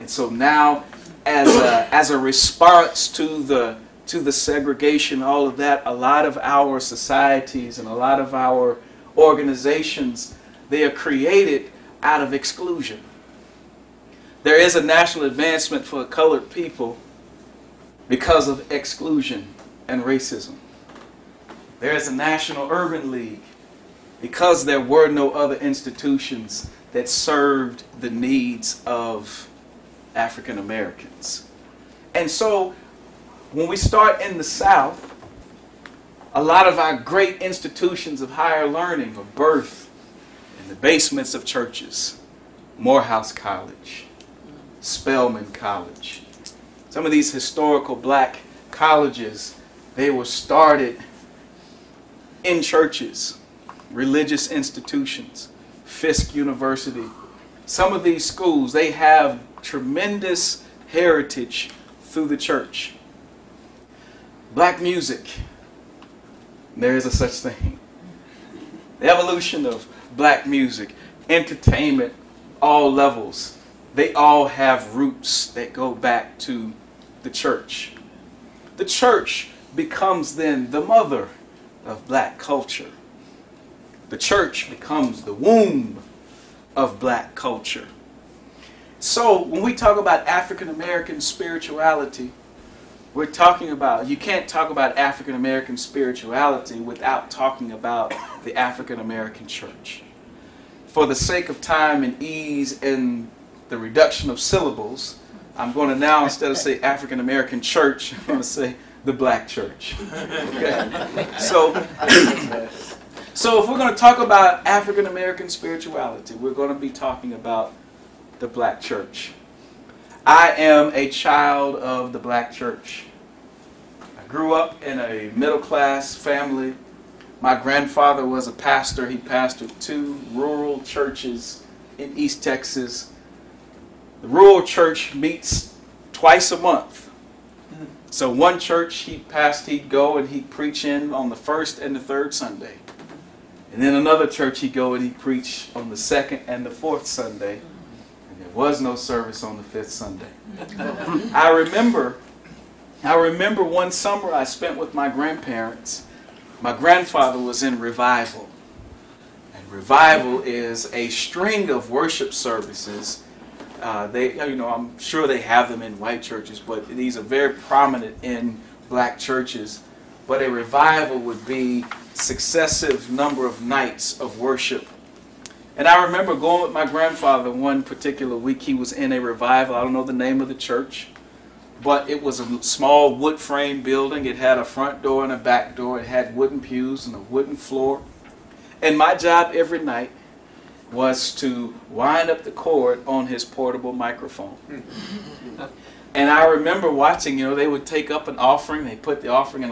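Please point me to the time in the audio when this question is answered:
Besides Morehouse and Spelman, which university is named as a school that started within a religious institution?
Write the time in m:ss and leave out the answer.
0:55.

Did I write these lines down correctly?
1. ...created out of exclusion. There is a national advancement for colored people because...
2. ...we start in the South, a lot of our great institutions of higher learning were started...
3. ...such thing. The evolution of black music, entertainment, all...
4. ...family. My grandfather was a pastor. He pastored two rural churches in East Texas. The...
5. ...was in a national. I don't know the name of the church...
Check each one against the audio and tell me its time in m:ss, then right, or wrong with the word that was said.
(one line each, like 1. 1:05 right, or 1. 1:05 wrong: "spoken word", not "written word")
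1. 0:10 right
2. 0:33 wrong: "birthed", not "started"
3. 1:07 right
4. 2:06 right
5. 2:58 wrong: "revival", not "national".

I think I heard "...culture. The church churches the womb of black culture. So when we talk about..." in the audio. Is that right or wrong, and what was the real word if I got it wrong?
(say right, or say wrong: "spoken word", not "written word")
wrong: "becomes", not "churches".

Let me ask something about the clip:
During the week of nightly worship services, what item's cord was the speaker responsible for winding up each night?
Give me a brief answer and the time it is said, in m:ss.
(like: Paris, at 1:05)
Portable microphone, at 3:13.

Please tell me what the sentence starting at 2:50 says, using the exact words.
But a revival would be successive number of nights of worship.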